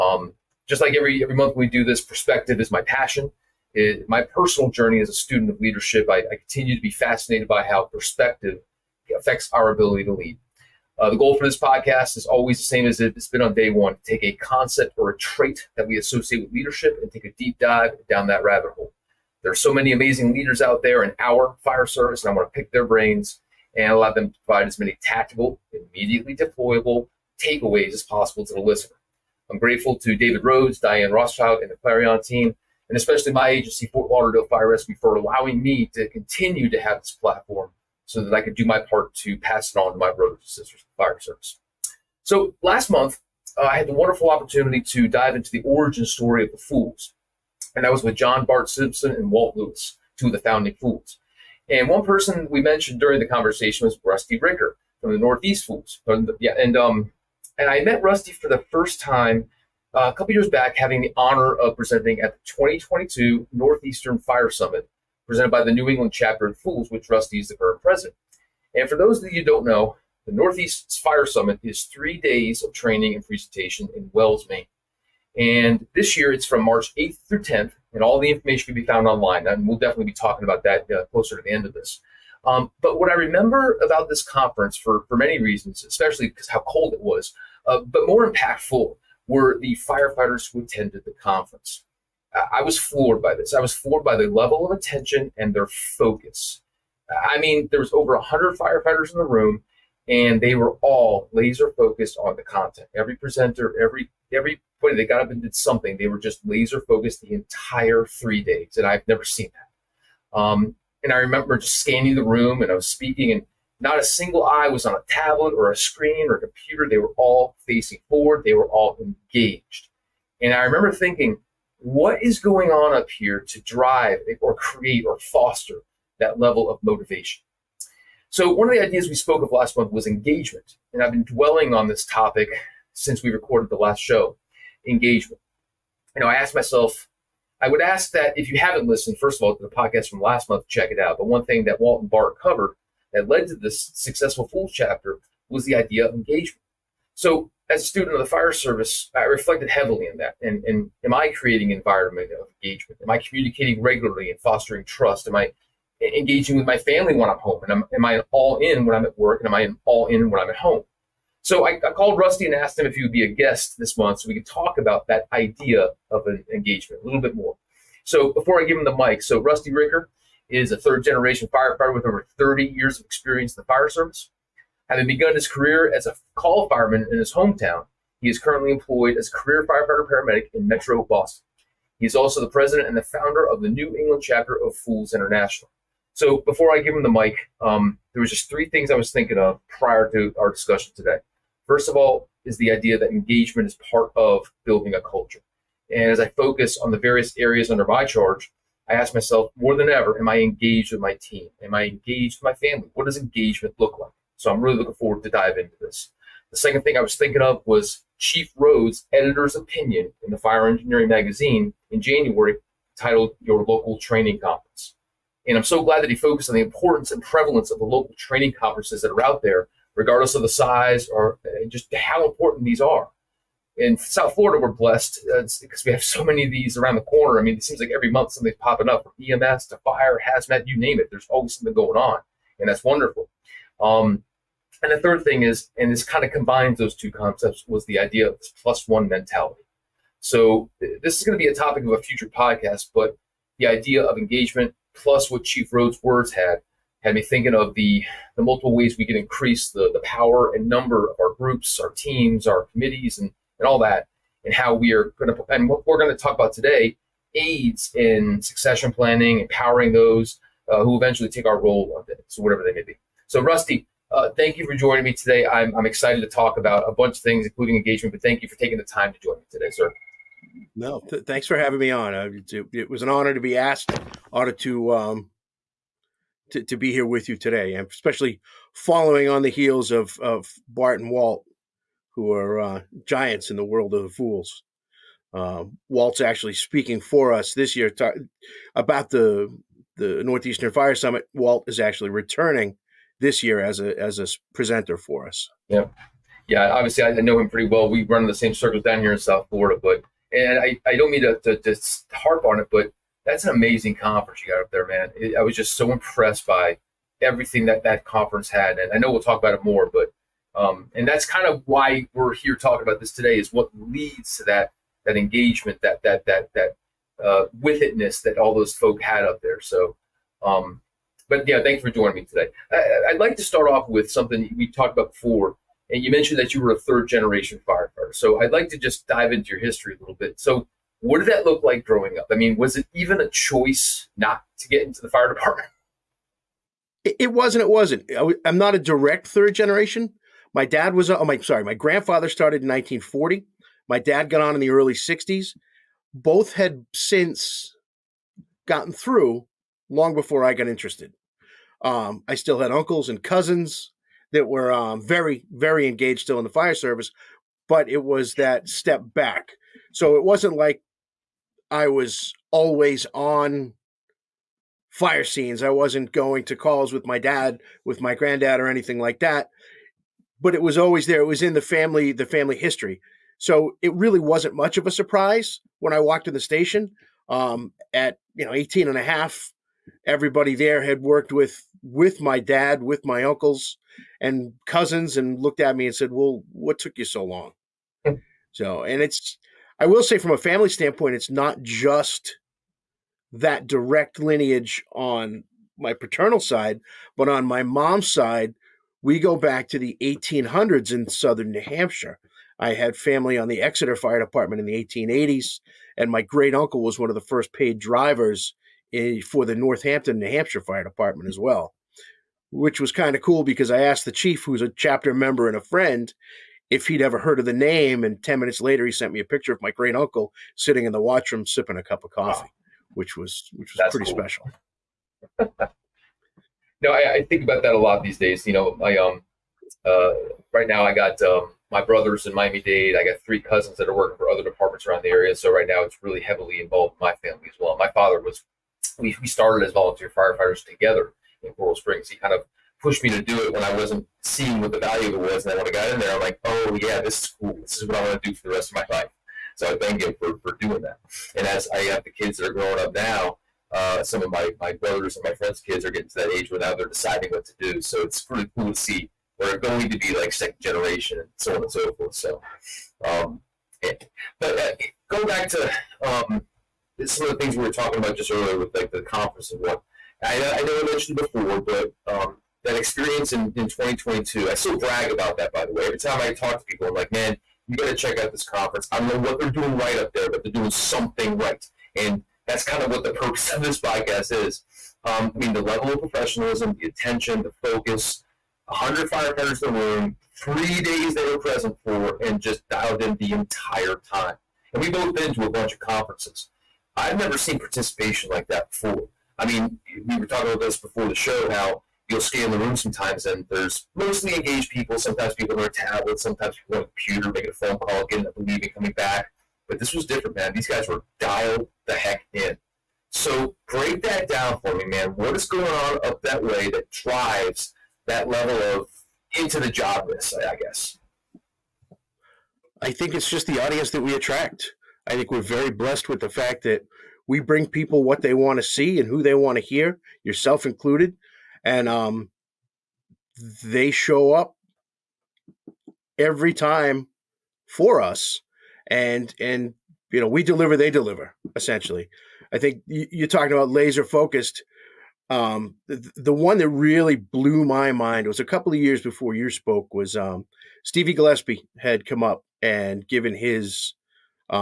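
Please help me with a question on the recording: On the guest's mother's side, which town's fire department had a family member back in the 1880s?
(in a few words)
Exeter.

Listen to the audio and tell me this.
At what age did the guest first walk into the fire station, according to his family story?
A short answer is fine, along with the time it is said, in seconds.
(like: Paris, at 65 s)
18 and a half, at 378 s.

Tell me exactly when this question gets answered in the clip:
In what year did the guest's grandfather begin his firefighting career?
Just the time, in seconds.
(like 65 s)
342 s.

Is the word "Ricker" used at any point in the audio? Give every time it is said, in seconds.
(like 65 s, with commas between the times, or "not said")
54 s, 169 s.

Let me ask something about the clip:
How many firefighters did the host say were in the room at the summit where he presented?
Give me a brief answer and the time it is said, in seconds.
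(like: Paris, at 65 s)
over 100, at 97 s.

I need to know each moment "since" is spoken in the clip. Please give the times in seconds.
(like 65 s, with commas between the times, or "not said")
132 s, 346 s.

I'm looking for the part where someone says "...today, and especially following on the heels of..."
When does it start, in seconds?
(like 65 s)
277 s.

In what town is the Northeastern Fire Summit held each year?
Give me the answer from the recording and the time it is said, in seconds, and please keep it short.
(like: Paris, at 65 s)
Wells, Maine, at 74 s.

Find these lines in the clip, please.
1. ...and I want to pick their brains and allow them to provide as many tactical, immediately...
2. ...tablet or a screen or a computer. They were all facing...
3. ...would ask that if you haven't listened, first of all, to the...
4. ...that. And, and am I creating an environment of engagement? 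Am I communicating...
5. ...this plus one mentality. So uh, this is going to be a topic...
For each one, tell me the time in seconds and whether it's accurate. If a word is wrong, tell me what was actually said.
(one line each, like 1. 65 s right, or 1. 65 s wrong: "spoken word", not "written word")
1. 22 s right
2. 115 s right
3. 137 s right
4. 150 s right
5. 238 s right.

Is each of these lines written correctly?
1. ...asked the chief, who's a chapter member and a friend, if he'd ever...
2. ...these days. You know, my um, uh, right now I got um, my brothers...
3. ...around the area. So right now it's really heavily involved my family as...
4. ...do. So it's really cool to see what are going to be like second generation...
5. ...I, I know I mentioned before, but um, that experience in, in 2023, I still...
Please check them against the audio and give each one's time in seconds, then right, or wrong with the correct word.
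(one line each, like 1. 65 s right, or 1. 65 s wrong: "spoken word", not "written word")
1. 413 s right
2. 428 s right
3. 434 s right
4. 457 s right
5. 470 s wrong: "2022", not "2023".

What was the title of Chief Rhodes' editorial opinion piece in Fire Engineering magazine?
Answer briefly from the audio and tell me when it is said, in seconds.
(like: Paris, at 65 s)
Your Local Training Conference, at 213 s.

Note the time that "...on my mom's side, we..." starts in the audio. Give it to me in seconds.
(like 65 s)
397 s.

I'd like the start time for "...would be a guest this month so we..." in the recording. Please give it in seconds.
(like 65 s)
163 s.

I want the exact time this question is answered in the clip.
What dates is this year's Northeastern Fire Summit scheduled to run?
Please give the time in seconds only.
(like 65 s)
76 s.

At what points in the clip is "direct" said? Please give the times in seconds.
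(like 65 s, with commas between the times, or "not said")
338 s, 393 s.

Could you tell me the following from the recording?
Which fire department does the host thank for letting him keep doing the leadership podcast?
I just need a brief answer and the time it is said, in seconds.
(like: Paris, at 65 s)
Fort Lauderdale Fire Rescue, at 33 s.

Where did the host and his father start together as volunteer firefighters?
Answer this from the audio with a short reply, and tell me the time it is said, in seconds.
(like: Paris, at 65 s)
Coral Springs, at 441 s.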